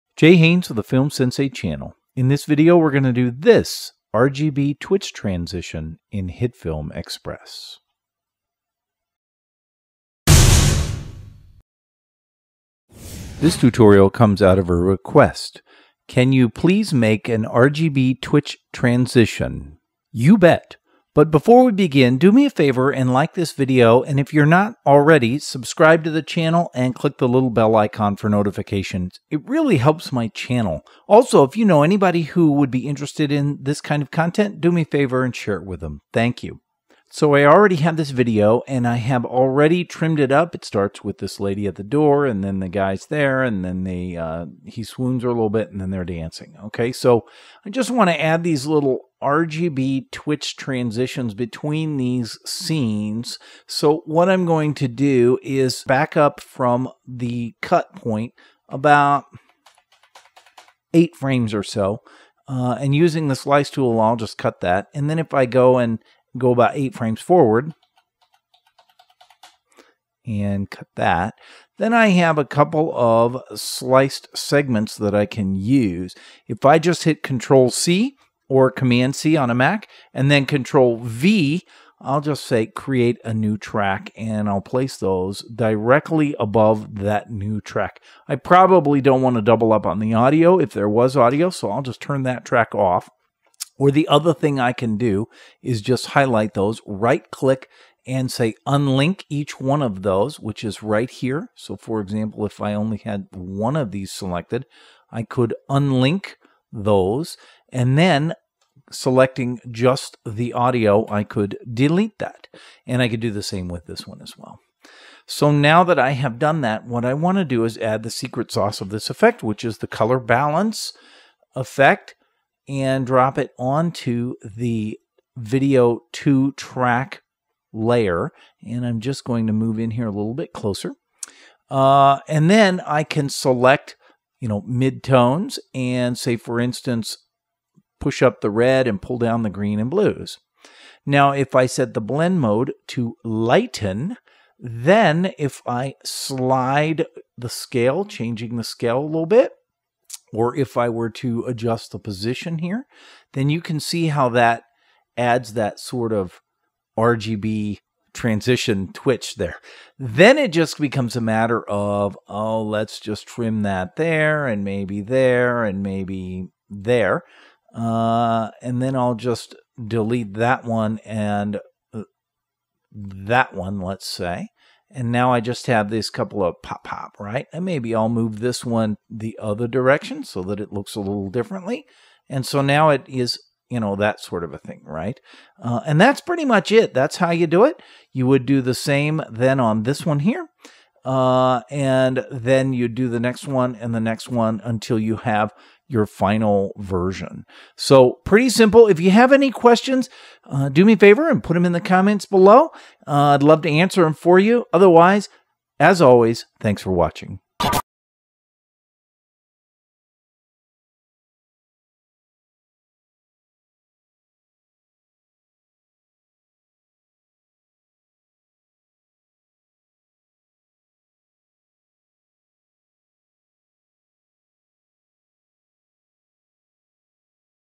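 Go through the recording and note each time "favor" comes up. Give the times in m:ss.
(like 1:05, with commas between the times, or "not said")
0:22, 0:34, 3:20.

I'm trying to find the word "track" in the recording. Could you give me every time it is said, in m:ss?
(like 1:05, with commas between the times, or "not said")
1:23, 1:27, 1:32, 2:06.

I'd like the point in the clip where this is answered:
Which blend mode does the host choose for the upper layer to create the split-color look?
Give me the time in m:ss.
2:23.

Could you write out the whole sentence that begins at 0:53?
So what I'm going to do is back up from the cut point about eight frames or so.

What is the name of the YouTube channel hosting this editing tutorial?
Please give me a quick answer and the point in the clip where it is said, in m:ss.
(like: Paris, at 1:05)
Film Sensei, at 0:00.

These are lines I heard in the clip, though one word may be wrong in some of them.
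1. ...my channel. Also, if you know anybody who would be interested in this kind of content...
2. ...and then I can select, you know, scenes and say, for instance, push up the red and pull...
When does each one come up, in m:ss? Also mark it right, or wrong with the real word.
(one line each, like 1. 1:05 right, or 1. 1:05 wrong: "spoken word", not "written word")
1. 0:30 right
2. 2:12 wrong: "midtones", not "scenes".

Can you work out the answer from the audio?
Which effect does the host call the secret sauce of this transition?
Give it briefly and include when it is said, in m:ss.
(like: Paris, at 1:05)
color balance, at 1:59.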